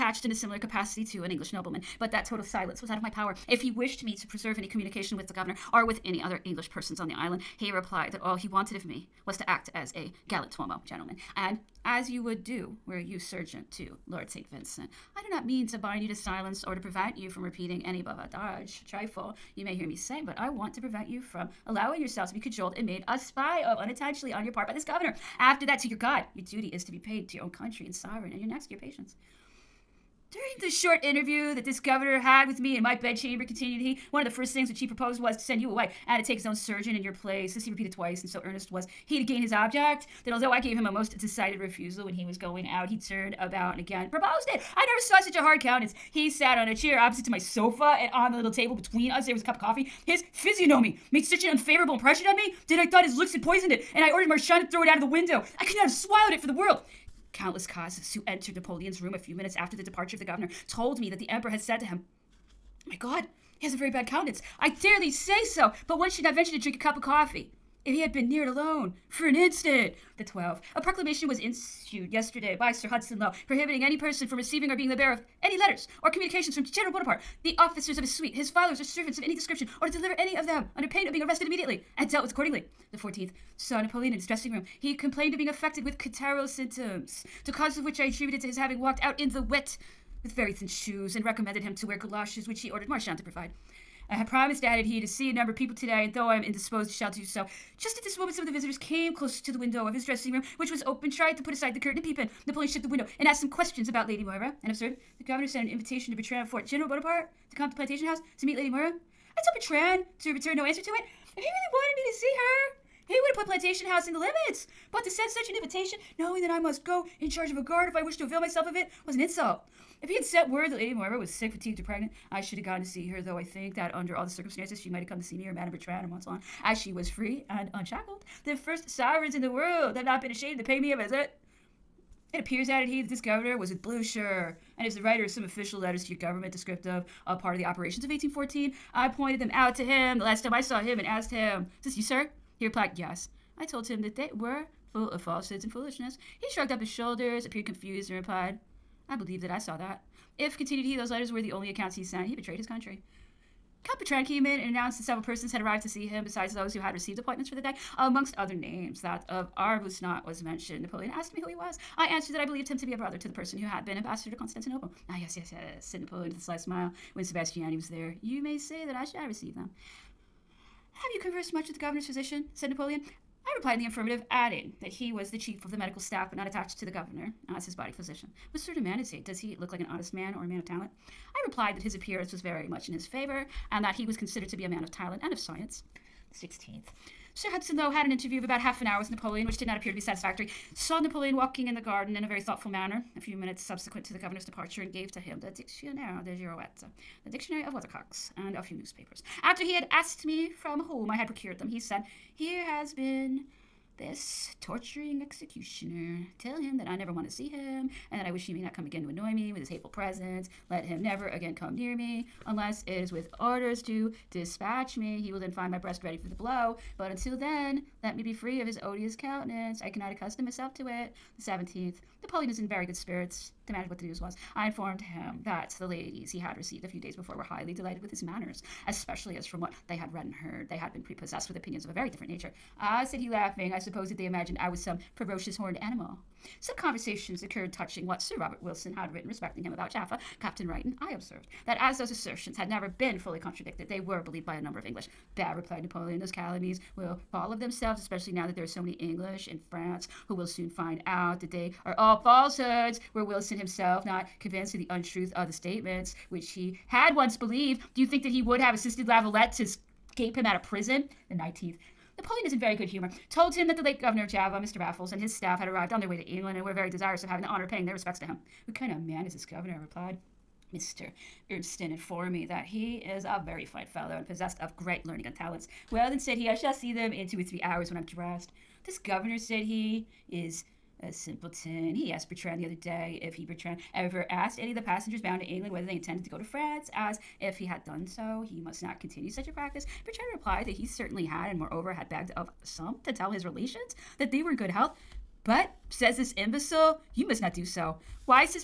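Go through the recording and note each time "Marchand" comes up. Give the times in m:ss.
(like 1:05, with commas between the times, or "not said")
0:54, 1:32.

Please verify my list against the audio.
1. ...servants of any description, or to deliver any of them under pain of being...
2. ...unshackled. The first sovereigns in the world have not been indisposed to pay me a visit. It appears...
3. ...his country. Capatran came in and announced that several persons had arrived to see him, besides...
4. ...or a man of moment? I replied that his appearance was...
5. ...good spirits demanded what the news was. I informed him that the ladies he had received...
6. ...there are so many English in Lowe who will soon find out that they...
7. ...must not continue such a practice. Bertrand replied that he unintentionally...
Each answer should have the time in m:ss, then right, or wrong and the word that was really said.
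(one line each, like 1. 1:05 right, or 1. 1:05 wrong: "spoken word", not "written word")
1. 1:18 right
2. 2:07 wrong: "ashamed", not "indisposed"
3. 2:32 right
4. 3:00 wrong: "talent", not "moment"
5. 3:42 right
6. 4:08 wrong: "France", not "Lowe"
7. 4:48 wrong: "certainly", not "unintentionally".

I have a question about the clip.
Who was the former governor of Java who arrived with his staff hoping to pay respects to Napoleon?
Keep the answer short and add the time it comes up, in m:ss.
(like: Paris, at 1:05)
Mr. Raffles, at 4:24.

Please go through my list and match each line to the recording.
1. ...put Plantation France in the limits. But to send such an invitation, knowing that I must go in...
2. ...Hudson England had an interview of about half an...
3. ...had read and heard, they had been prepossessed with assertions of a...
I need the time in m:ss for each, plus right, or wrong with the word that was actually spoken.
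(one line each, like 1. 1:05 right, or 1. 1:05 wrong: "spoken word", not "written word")
1. 1:53 wrong: "House", not "France"
2. 3:07 wrong: "Lowe", not "England"
3. 3:49 wrong: "opinions", not "assertions".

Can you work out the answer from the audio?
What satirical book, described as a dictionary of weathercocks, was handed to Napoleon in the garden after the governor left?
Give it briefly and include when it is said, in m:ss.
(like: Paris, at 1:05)
Dictionnaire de Girouette, at 3:15.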